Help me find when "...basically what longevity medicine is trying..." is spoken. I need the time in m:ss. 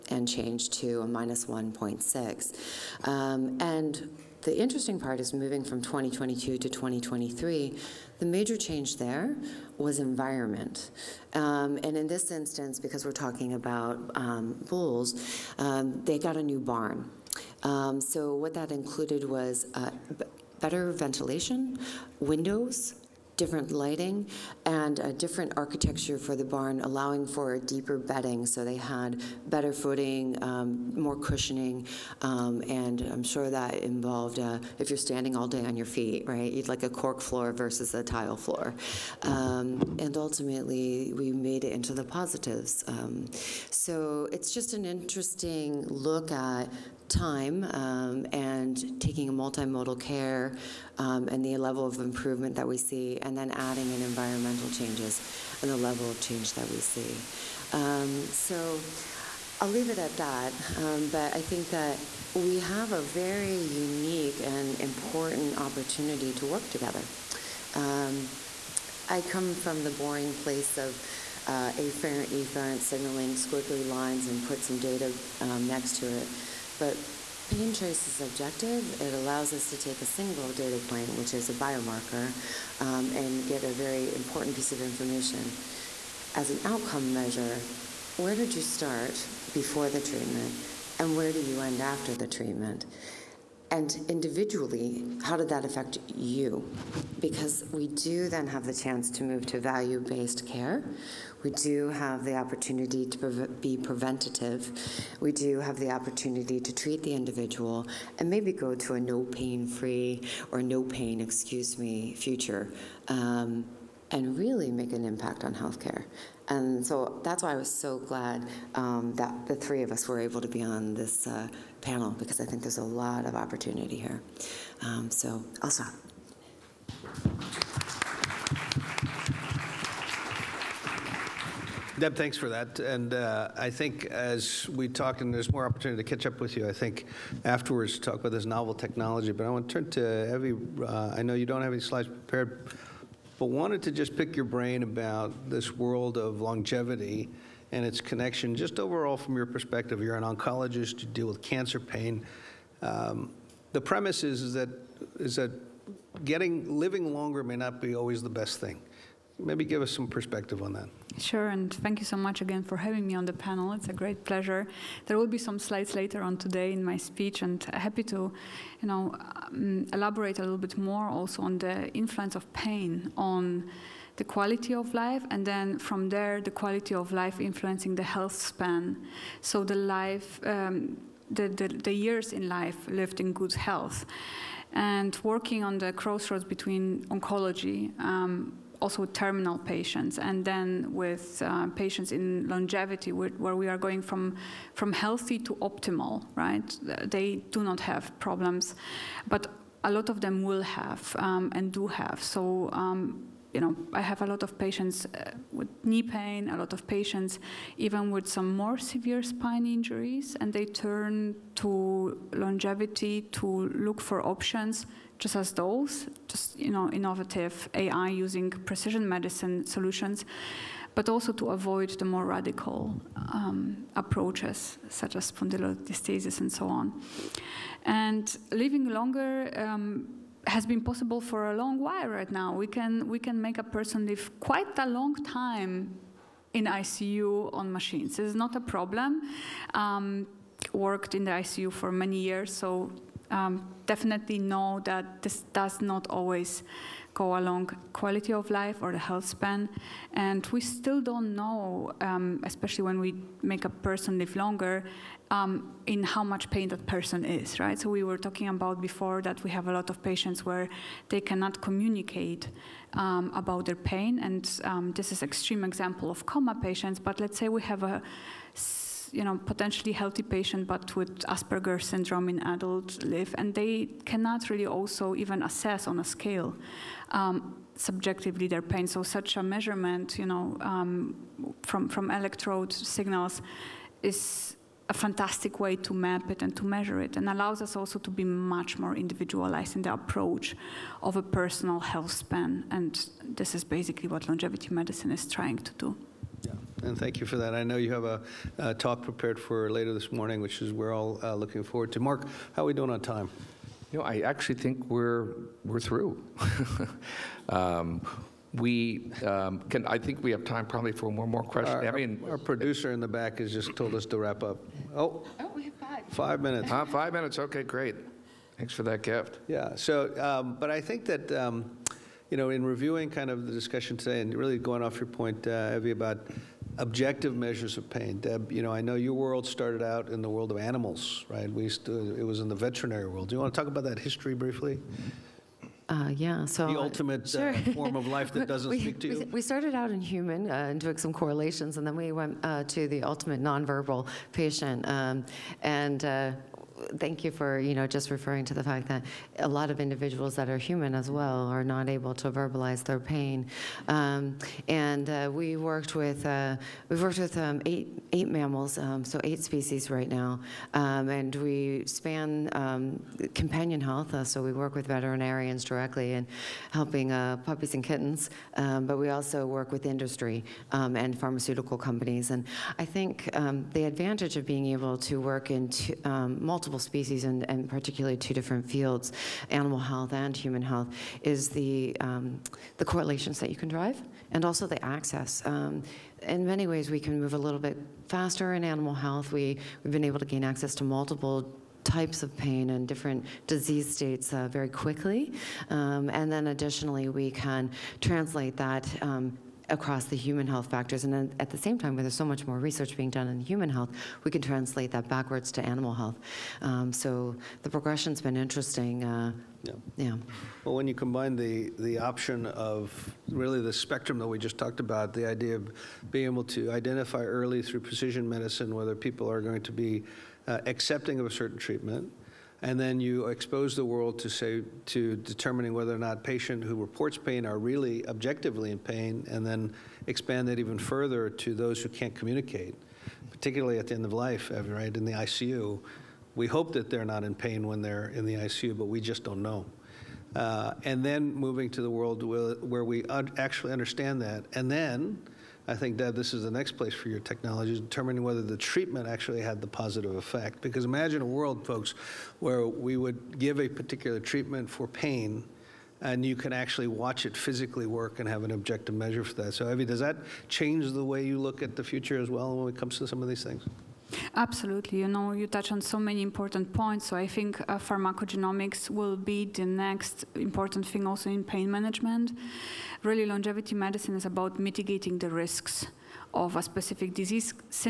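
4:53.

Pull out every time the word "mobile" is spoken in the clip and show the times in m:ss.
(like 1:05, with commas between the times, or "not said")
not said.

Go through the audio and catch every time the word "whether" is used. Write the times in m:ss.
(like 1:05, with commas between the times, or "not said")
6:58, 7:05, 7:28.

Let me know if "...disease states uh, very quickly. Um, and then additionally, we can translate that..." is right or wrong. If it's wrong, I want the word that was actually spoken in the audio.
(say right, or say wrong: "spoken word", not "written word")
right.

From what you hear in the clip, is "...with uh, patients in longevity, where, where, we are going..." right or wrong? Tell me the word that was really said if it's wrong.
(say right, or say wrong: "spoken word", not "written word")
right.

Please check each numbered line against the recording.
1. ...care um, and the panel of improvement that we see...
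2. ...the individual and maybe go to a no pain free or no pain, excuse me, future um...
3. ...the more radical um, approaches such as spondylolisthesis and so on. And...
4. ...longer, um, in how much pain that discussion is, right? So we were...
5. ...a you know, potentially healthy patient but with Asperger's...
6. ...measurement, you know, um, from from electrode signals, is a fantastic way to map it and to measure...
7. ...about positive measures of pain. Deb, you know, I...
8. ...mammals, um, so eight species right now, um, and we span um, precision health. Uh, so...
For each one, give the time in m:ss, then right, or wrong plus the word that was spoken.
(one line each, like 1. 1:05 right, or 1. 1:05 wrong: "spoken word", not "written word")
1. 0:50 wrong: "level", not "panel"
2. 1:47 right
3. 3:41 right
4. 4:14 wrong: "person", not "discussion"
5. 4:27 right
6. 4:39 right
7. 5:25 wrong: "objective", not "positive"
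8. 5:58 wrong: "companion", not "precision".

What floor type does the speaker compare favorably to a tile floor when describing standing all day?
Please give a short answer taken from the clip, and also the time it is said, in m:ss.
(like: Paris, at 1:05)
Cork floor, at 0:36.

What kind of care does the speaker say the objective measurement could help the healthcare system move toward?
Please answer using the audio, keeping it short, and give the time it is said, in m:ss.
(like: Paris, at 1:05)
Value based care, at 1:39.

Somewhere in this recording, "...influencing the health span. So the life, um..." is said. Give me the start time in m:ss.
2:57.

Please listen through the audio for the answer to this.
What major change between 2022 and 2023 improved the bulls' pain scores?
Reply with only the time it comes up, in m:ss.
0:09.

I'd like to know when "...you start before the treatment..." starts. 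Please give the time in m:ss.
1:28.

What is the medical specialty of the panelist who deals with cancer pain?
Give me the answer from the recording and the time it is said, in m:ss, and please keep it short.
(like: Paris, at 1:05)
Oncologist, at 2:30.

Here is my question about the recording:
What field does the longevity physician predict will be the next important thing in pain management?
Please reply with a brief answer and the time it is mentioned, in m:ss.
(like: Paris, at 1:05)
Pharmacogenomics, at 7:47.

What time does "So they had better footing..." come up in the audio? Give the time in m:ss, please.
0:28.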